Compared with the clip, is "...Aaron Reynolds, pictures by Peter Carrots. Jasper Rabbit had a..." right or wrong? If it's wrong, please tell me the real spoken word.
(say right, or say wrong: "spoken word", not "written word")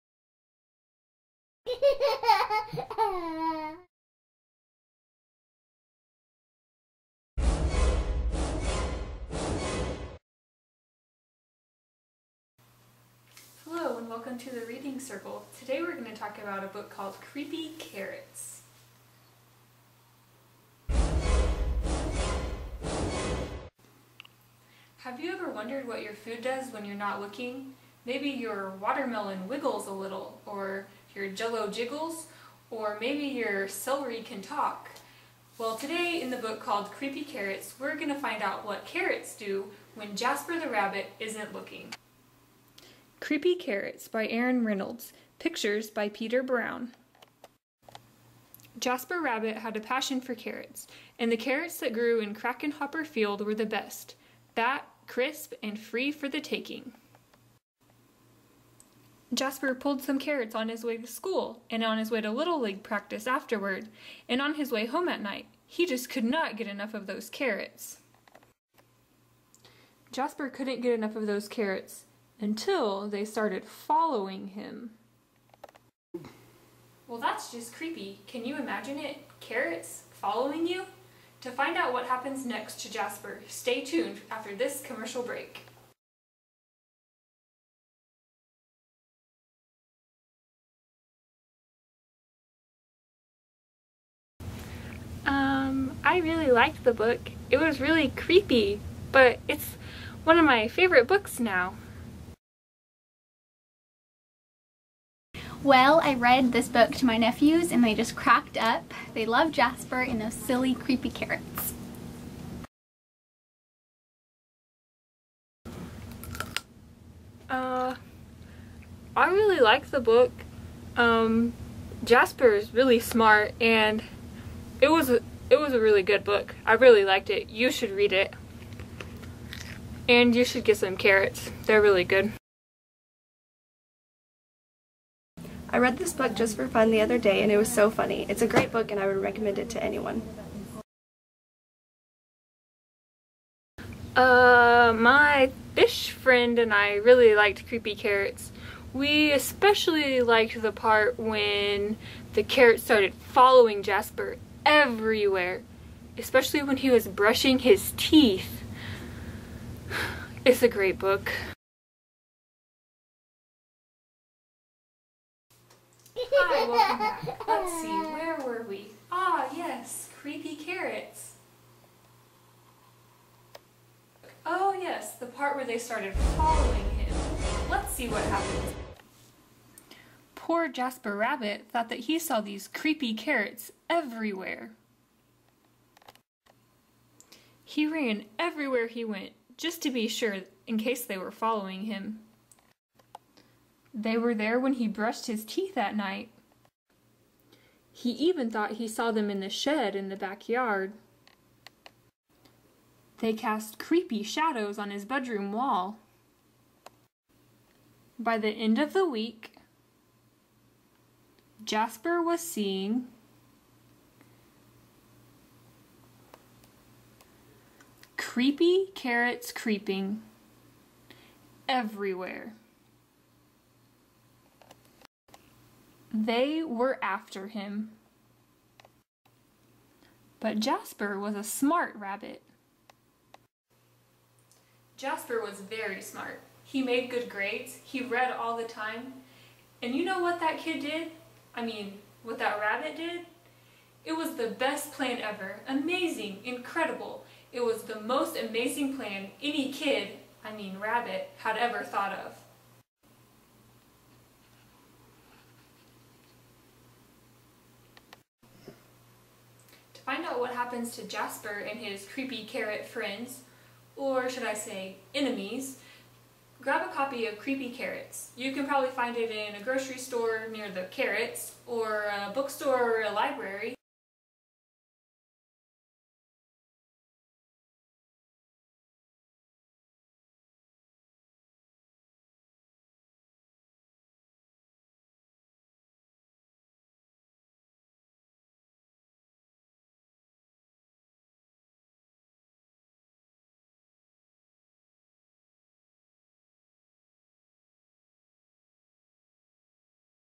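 wrong: "Brown", not "Carrots".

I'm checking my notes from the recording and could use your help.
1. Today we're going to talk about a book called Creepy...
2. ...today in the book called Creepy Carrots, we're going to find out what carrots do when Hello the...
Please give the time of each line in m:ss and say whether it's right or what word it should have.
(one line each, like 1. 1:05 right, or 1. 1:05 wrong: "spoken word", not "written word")
1. 0:15 right
2. 0:35 wrong: "Jasper", not "Hello".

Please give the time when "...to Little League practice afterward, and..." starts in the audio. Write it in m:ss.
1:02.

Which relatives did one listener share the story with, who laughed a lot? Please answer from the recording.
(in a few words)
nephews.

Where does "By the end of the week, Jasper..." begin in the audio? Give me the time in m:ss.
3:28.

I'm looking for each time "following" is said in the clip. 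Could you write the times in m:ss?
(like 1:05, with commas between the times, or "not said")
1:13, 1:20, 2:33, 2:56, 3:11.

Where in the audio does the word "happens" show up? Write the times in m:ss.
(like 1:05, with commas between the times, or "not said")
1:22, 2:58, 4:20.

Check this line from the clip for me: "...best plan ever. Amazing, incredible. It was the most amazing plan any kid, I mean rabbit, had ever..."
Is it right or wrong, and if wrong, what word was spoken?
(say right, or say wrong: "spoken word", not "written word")
right.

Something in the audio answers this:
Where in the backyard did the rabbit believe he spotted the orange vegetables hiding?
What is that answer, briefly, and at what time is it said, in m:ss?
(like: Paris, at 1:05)
the shed, at 3:19.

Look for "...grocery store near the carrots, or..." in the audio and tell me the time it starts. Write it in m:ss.
4:29.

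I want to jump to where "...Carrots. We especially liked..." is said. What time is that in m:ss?
2:27.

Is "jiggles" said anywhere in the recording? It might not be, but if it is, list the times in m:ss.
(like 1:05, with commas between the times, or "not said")
0:31.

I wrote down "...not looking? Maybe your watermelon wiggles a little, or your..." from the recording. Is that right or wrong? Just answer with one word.
right.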